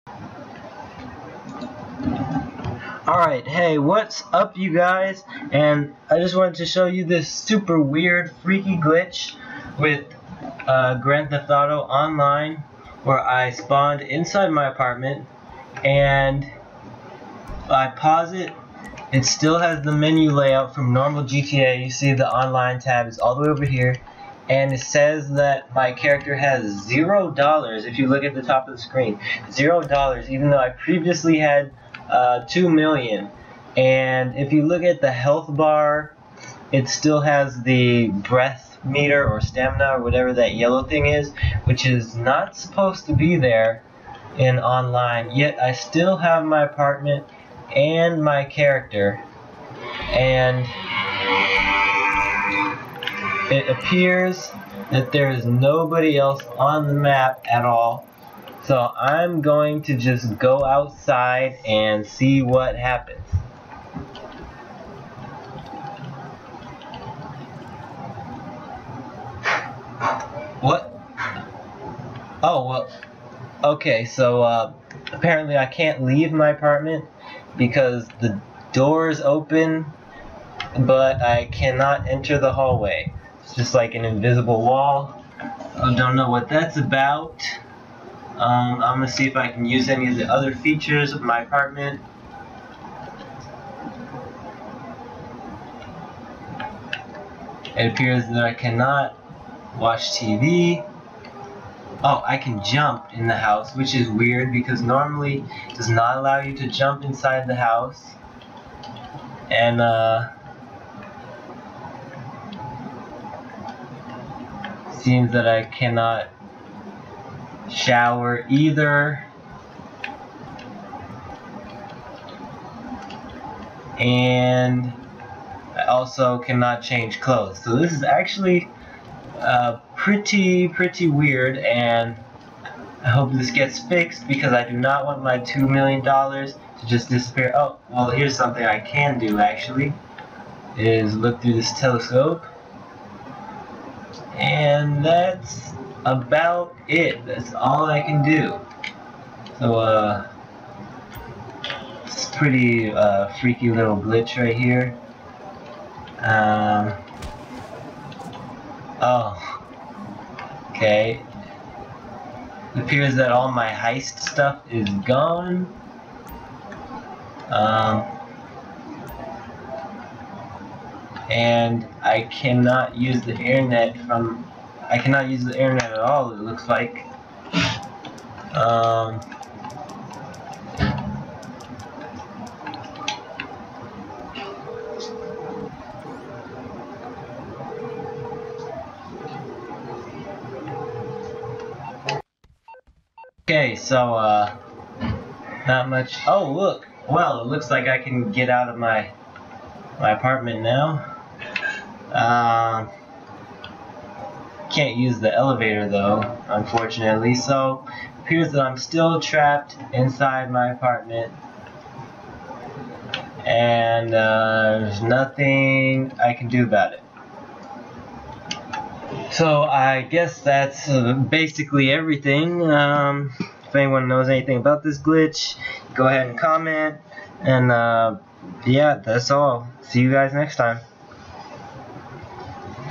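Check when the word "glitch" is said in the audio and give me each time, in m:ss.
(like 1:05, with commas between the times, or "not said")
0:08, 2:33, 3:44.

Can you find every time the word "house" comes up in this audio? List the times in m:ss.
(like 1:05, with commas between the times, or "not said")
1:43, 1:47.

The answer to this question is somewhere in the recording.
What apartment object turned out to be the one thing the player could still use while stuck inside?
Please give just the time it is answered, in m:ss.
2:21.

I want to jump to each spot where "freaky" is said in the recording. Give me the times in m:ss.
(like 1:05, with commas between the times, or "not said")
0:08, 2:33.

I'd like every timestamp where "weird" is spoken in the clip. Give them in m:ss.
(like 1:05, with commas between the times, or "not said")
0:07, 1:44, 2:11.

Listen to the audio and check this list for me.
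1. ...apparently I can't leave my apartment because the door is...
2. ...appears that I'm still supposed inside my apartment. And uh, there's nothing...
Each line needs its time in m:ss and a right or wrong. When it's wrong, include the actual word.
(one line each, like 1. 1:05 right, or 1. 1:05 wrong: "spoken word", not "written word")
1. 1:15 right
2. 3:28 wrong: "trapped", not "supposed".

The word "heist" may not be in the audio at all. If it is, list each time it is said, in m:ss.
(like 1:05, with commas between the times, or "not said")
2:43.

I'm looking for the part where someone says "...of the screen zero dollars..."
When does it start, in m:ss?
0:28.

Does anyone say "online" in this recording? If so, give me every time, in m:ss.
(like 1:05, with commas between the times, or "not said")
0:11, 0:22, 0:44.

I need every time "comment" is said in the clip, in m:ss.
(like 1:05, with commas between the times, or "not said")
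3:46.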